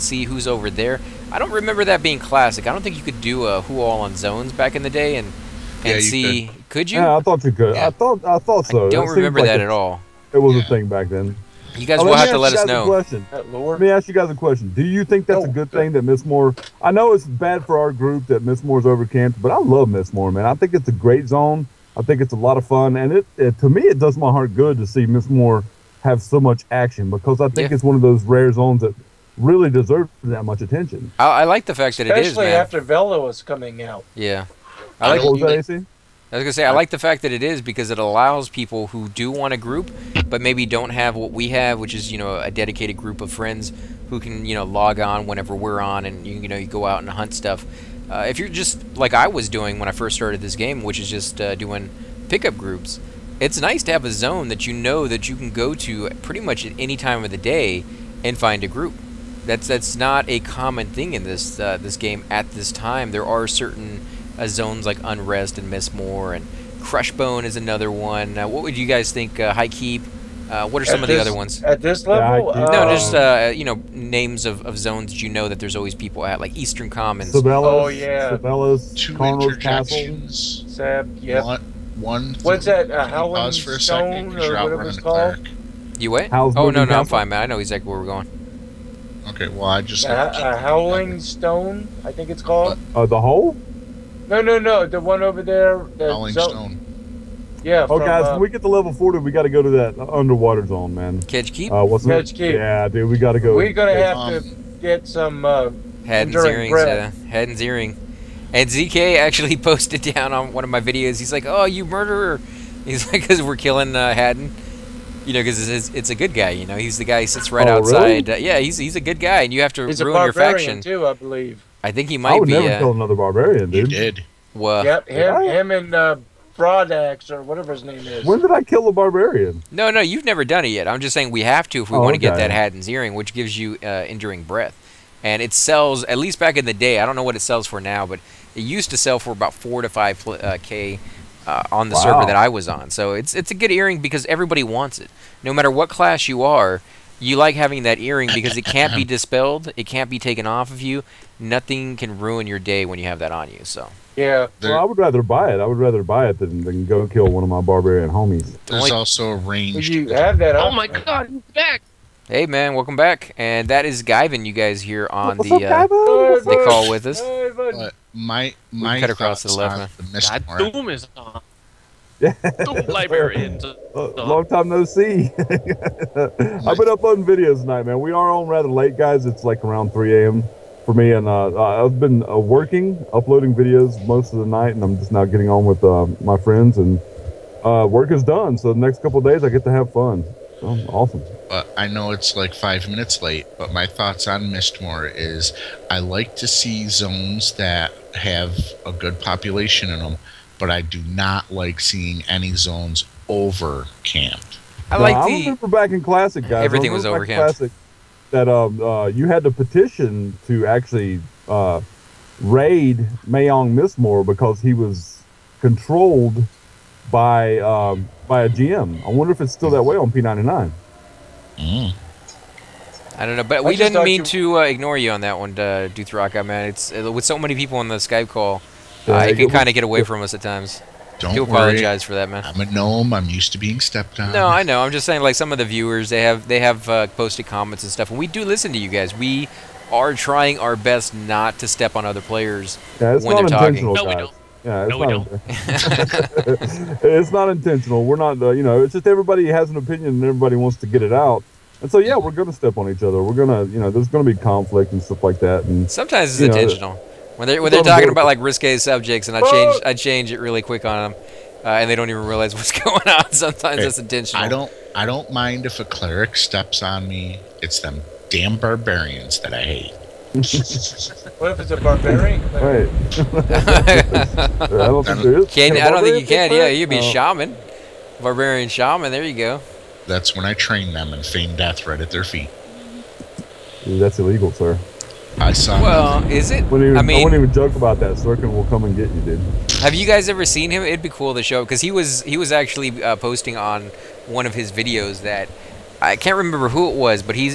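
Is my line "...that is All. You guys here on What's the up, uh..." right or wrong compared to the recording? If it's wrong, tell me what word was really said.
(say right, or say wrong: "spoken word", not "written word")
wrong: "Guyvan", not "All".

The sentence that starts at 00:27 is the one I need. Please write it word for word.
it's one of those rare zones that really deserves that much attention.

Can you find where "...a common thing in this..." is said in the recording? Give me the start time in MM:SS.
01:00.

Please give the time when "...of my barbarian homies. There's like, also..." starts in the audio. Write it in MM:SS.
02:37.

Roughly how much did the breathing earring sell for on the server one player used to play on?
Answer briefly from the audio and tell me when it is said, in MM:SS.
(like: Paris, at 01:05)
4 to 5k, at 02:19.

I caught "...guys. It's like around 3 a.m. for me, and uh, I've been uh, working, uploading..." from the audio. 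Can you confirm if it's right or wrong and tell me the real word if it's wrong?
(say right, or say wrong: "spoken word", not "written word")
right.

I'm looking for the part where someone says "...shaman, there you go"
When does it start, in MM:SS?
04:38.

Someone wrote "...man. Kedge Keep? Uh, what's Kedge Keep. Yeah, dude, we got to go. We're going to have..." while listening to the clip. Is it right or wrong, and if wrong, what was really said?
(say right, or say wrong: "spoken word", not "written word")
right.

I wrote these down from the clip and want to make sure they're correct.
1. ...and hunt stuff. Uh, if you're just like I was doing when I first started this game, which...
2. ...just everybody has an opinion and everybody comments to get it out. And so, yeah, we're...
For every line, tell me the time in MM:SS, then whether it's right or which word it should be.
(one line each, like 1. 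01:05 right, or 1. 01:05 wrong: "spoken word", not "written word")
1. 00:46 right
2. 04:08 wrong: "wants", not "comments".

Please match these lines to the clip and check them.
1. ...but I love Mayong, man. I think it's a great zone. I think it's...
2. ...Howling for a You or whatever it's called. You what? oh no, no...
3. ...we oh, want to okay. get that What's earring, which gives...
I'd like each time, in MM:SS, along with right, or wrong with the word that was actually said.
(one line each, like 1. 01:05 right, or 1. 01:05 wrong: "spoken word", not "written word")
1. 00:19 wrong: "Mistmoore", not "Mayong"
2. 01:23 wrong: "Stone", not "You"
3. 02:11 wrong: "Hadden", not "What".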